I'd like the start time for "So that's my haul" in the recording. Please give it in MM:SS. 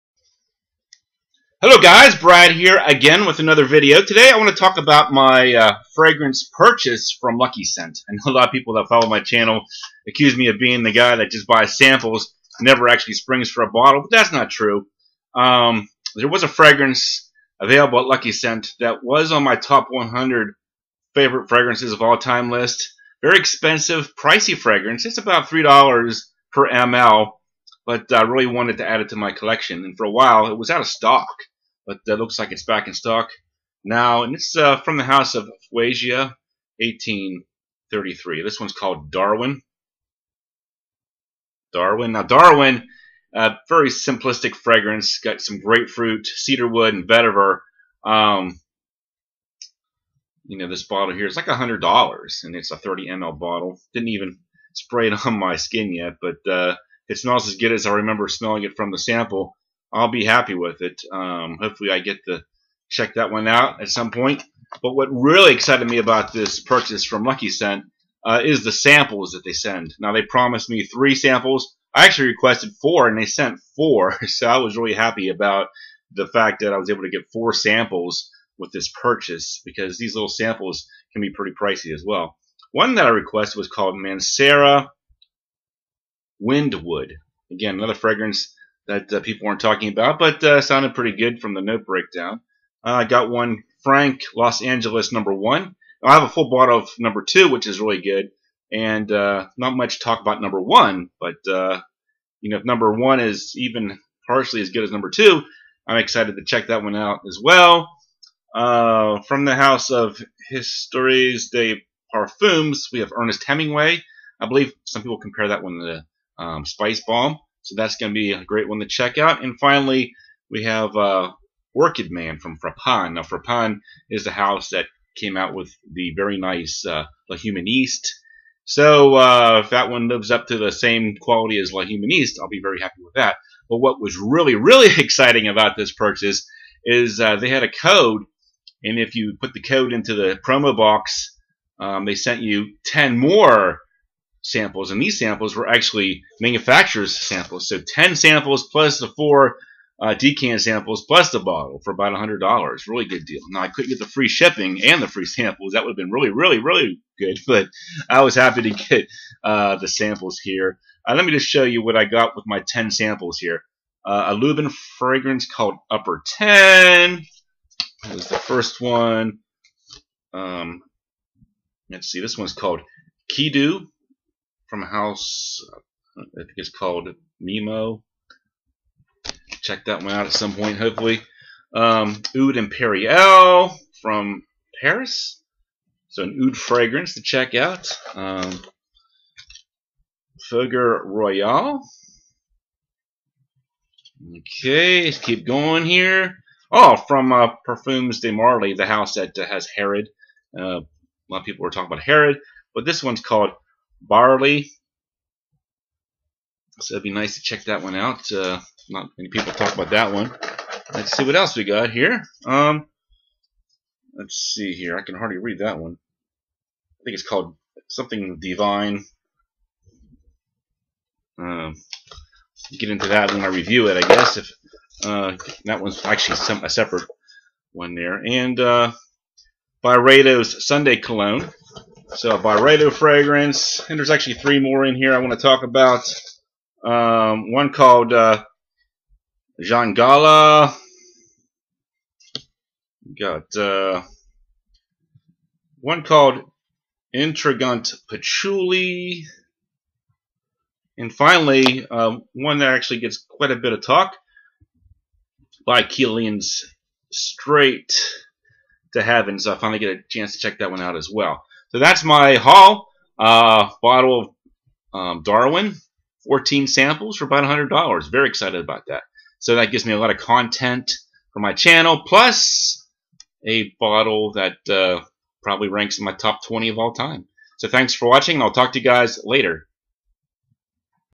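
04:21.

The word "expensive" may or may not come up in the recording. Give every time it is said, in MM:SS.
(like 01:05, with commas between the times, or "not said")
00:23.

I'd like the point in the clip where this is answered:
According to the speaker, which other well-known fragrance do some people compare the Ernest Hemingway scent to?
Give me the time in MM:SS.
01:56.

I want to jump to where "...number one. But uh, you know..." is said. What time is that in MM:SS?
01:40.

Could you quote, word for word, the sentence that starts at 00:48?
Um, you know, this bottle here is like $100, and it's a 30 ml bottle.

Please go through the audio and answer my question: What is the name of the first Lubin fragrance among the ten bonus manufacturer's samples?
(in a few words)
Upper 10.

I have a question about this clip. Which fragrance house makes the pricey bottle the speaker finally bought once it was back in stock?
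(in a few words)
Fueguia 1833.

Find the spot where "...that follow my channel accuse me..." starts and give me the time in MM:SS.
00:08.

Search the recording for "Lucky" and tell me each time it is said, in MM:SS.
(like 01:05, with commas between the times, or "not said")
00:07, 00:18, 01:07.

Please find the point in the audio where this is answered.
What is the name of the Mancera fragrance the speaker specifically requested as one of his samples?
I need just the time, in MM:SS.
01:26.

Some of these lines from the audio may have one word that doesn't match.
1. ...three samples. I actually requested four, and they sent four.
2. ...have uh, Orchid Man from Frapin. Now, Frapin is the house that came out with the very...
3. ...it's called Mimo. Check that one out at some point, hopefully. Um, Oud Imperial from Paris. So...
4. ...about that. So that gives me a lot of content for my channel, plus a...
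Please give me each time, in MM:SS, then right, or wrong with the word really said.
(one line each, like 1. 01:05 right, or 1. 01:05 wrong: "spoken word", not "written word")
1. 01:10 right
2. 02:00 right
3. 02:56 right
4. 04:28 right.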